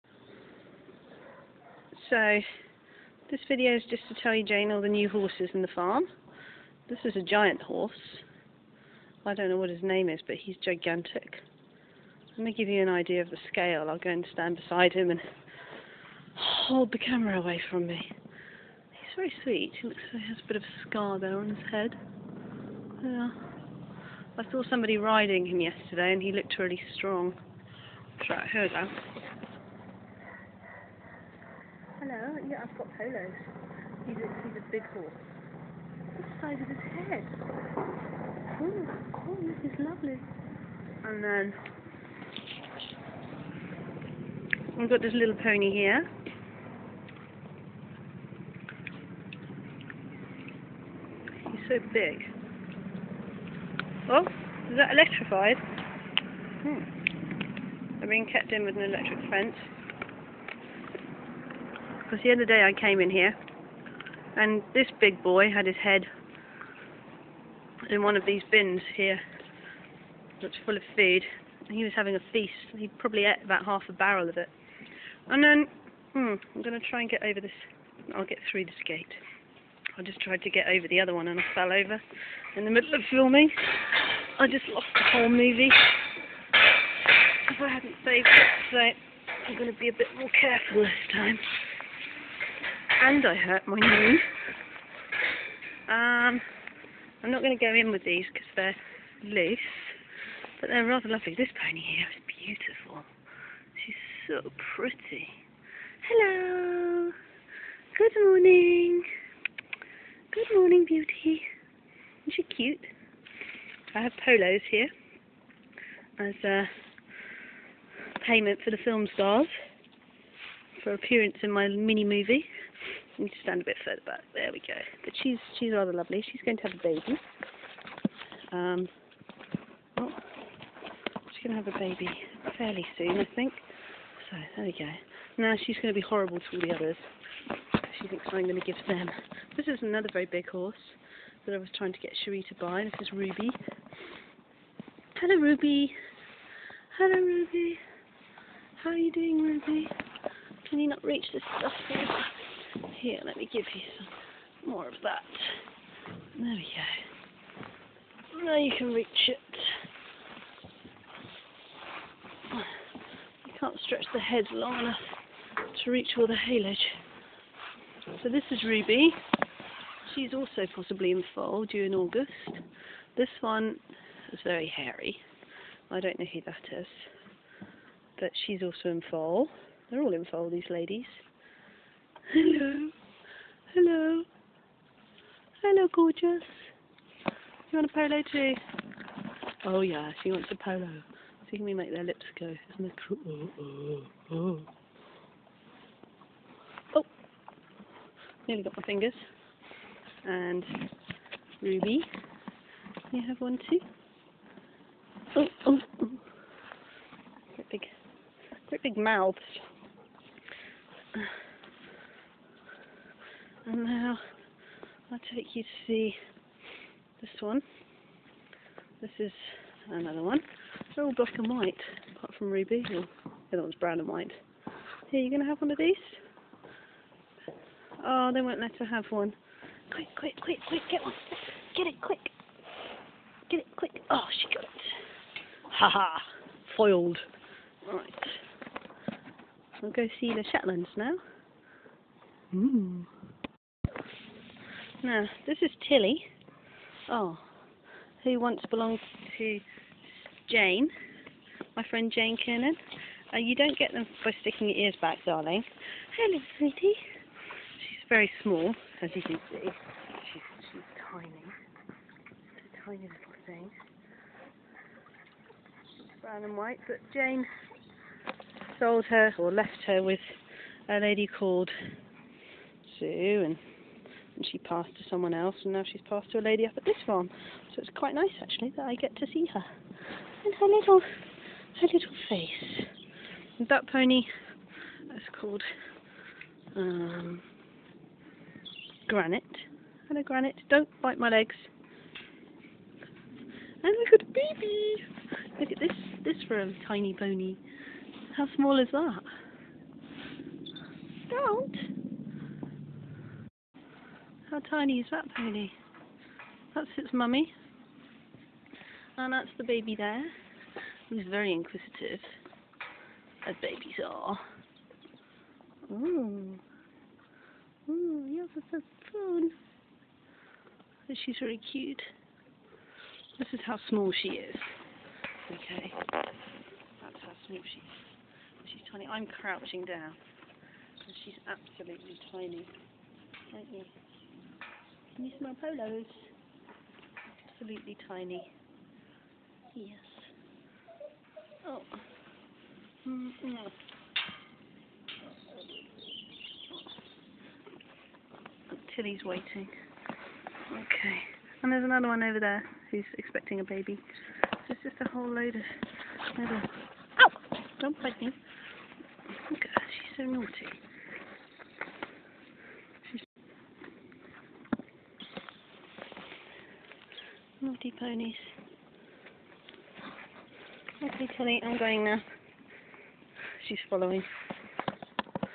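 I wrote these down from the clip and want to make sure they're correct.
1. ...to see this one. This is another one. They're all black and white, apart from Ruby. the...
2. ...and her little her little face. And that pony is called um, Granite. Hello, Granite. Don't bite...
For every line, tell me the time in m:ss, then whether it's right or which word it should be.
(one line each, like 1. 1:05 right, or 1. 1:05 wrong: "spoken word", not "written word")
1. 3:35 right
2. 4:40 right.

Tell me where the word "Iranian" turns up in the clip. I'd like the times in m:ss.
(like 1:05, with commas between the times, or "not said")
not said.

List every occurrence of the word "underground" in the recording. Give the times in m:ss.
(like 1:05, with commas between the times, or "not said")
not said.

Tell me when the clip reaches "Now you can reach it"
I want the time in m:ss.
2:38.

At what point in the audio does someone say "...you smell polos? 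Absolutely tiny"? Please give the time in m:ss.
5:35.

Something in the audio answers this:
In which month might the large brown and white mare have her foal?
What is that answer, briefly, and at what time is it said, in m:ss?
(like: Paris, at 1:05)
August, at 2:51.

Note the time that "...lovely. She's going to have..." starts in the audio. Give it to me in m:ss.
2:05.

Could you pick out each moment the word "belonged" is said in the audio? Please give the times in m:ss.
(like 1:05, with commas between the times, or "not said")
4:08.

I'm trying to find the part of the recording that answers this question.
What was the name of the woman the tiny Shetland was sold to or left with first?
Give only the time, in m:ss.
4:32.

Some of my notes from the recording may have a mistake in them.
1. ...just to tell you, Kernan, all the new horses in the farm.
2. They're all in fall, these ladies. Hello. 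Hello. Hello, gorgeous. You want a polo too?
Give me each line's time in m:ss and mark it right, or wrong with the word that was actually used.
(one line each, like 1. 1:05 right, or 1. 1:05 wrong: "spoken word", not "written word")
1. 0:03 wrong: "Jane", not "Kernan"
2. 2:59 right.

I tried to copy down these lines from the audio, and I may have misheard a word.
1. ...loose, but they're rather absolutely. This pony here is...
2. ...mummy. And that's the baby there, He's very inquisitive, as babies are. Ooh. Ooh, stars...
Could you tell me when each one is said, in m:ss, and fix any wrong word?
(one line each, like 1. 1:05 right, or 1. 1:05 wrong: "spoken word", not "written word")
1. 1:39 wrong: "lovely", not "absolutely"
2. 5:07 wrong: "yours", not "stars".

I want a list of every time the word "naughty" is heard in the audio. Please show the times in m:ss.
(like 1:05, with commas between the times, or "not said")
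6:00, 6:07.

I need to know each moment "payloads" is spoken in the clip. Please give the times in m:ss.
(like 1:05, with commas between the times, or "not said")
not said.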